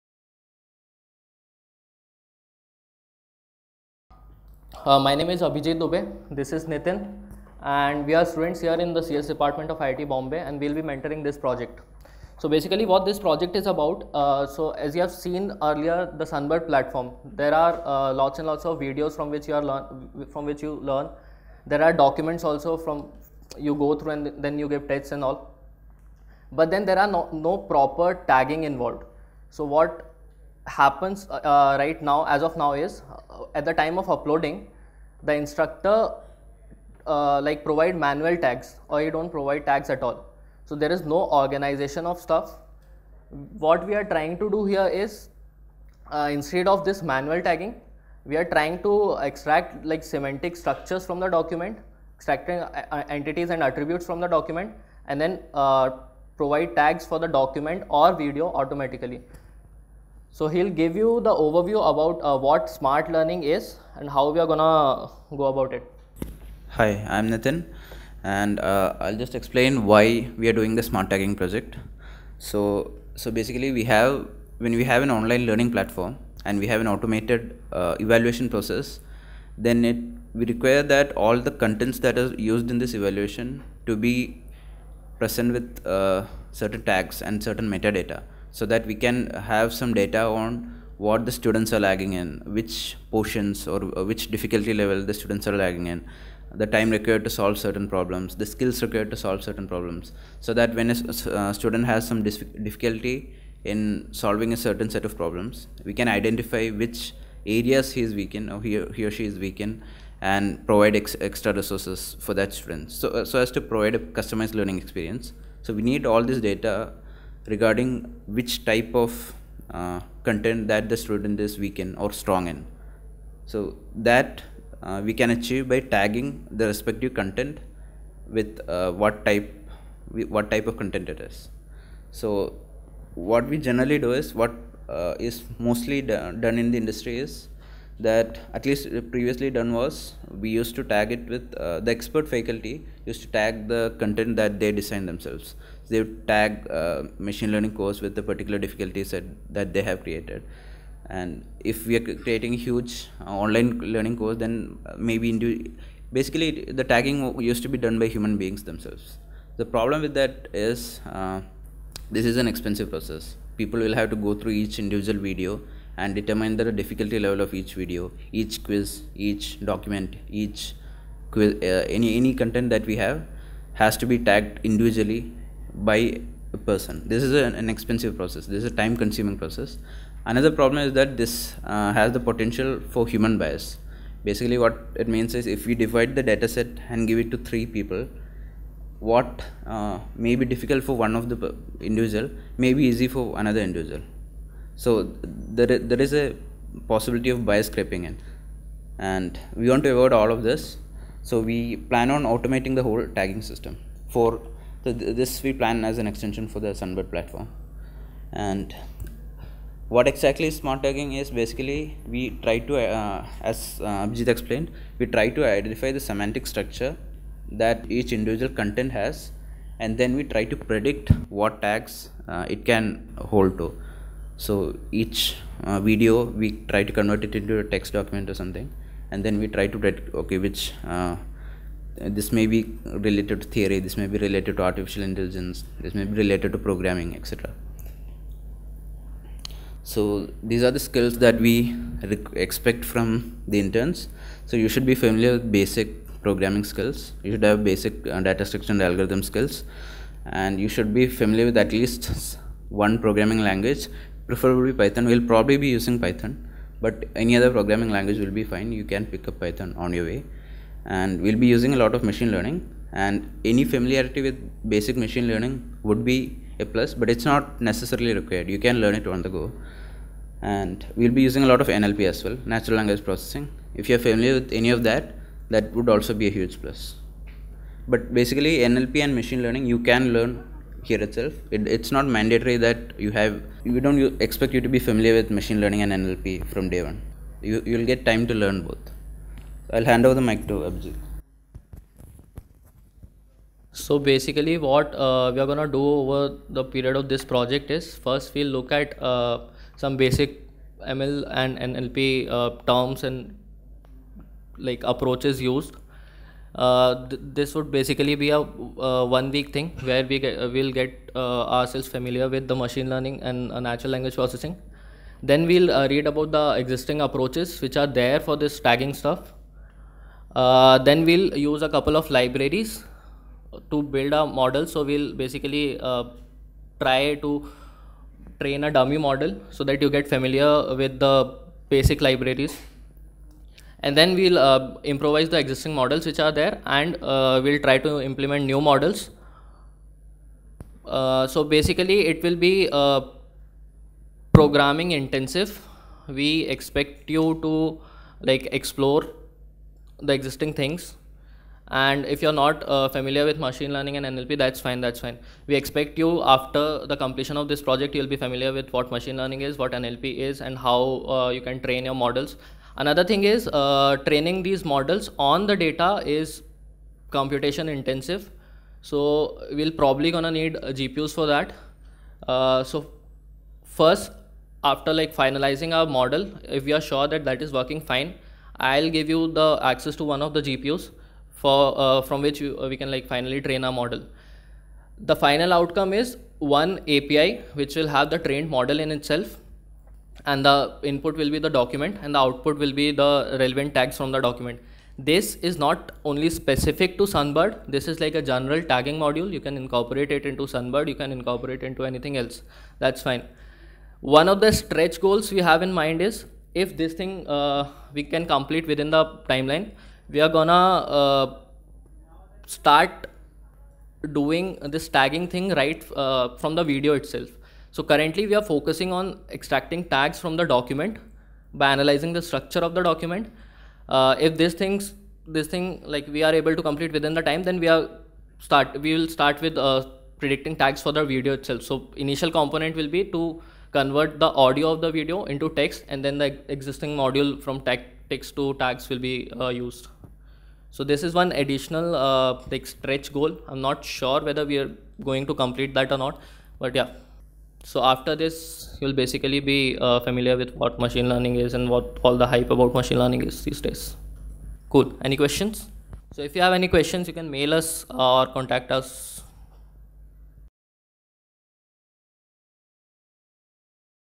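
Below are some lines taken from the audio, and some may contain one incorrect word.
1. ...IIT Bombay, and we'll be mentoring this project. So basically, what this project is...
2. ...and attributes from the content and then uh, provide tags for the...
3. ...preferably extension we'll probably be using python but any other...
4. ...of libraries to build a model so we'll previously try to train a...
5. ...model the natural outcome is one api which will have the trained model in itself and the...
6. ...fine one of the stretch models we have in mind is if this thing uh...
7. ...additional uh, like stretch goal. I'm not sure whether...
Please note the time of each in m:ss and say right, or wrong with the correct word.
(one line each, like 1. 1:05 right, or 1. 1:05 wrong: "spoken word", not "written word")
1. 0:09 right
2. 0:53 wrong: "document", not "content"
3. 4:14 wrong: "python", not "extension"
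4. 5:21 wrong: "basically", not "previously"
5. 6:23 wrong: "final", not "natural"
6. 6:43 wrong: "goals", not "models"
7. 7:21 right.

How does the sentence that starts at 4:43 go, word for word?
We don't expect you to be familiar with machine learning and NLP from day one.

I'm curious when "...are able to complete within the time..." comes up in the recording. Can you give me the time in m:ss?
7:06.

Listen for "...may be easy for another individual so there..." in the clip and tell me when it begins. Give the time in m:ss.
3:12.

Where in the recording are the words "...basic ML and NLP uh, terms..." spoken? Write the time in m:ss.
4:59.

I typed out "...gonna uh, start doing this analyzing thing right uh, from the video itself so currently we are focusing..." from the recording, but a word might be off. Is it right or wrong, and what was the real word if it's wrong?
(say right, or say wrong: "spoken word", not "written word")
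wrong: "tagging", not "analyzing".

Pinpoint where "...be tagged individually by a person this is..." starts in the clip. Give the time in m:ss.
2:54.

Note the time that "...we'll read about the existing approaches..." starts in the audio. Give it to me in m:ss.
5:15.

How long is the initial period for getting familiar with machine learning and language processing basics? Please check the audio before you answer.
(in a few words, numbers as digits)
one week.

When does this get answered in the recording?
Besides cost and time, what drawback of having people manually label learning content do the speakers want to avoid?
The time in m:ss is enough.
3:03.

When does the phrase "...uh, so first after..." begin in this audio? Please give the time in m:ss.
6:12.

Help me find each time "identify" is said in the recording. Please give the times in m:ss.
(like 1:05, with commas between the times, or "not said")
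1:46, 3:35.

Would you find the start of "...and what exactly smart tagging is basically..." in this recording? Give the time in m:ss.
3:28.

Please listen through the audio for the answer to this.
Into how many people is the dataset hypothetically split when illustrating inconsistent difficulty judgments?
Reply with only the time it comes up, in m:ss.
3:07.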